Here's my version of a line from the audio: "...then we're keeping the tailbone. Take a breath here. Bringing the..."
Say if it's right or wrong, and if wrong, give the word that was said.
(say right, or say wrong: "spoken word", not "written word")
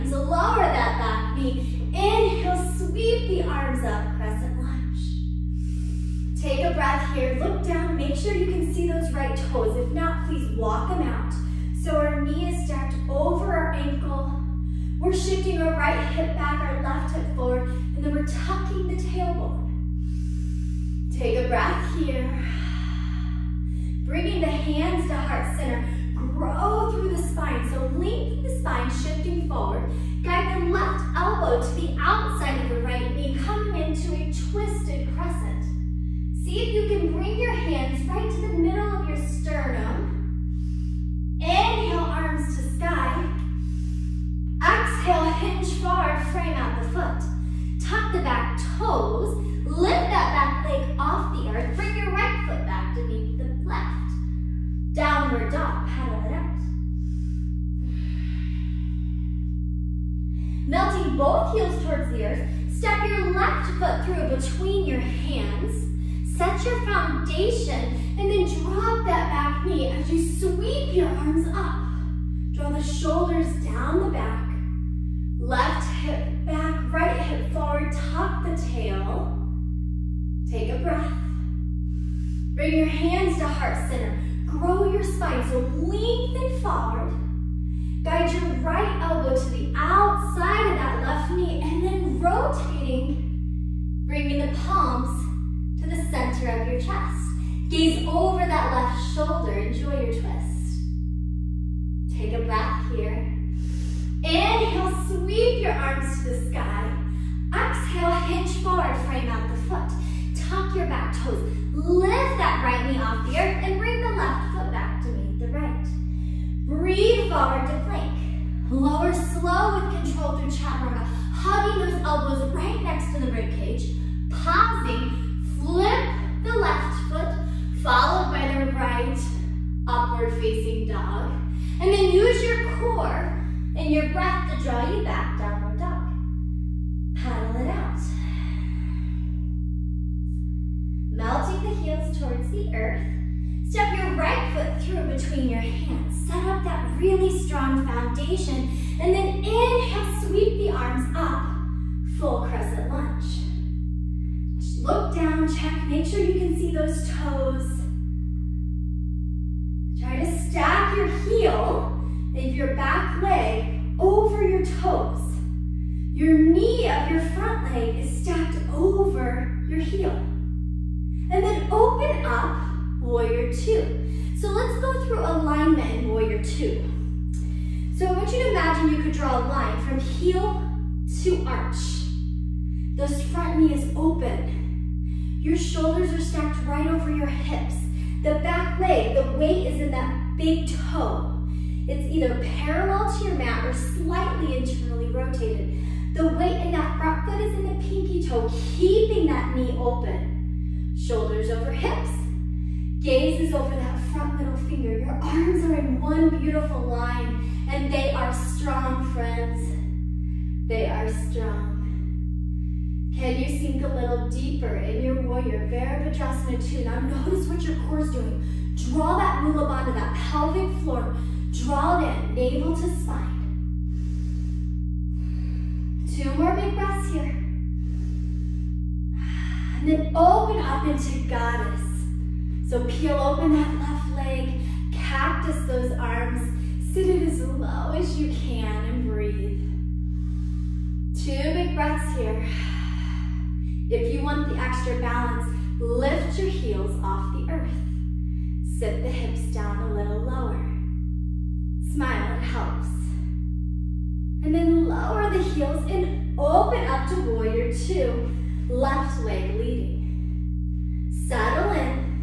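wrong: "tucking", not "keeping".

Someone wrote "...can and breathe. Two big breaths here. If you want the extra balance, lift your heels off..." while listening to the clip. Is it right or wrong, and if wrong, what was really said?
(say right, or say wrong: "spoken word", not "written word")
right.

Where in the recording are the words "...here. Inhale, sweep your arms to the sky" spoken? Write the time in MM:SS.
01:42.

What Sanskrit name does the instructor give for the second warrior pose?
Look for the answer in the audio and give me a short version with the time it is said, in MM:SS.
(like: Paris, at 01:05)
Virabhadrasana 2, at 03:35.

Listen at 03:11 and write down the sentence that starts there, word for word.
It's either parallel to your mat or slightly internally rotated.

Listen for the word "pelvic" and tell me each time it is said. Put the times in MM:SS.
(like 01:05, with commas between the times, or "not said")
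03:40.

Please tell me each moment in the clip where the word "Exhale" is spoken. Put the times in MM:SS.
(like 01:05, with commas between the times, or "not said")
00:44, 01:47.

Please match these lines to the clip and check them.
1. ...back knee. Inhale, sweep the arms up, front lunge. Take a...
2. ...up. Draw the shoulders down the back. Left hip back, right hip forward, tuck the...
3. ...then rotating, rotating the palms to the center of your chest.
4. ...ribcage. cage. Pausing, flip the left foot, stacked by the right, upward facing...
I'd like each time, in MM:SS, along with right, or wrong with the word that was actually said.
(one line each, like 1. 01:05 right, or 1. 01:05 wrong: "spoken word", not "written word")
1. 00:01 wrong: "crescent", not "front"
2. 01:11 right
3. 01:31 wrong: "bringing", not "rotating"
4. 02:03 wrong: "followed", not "stacked".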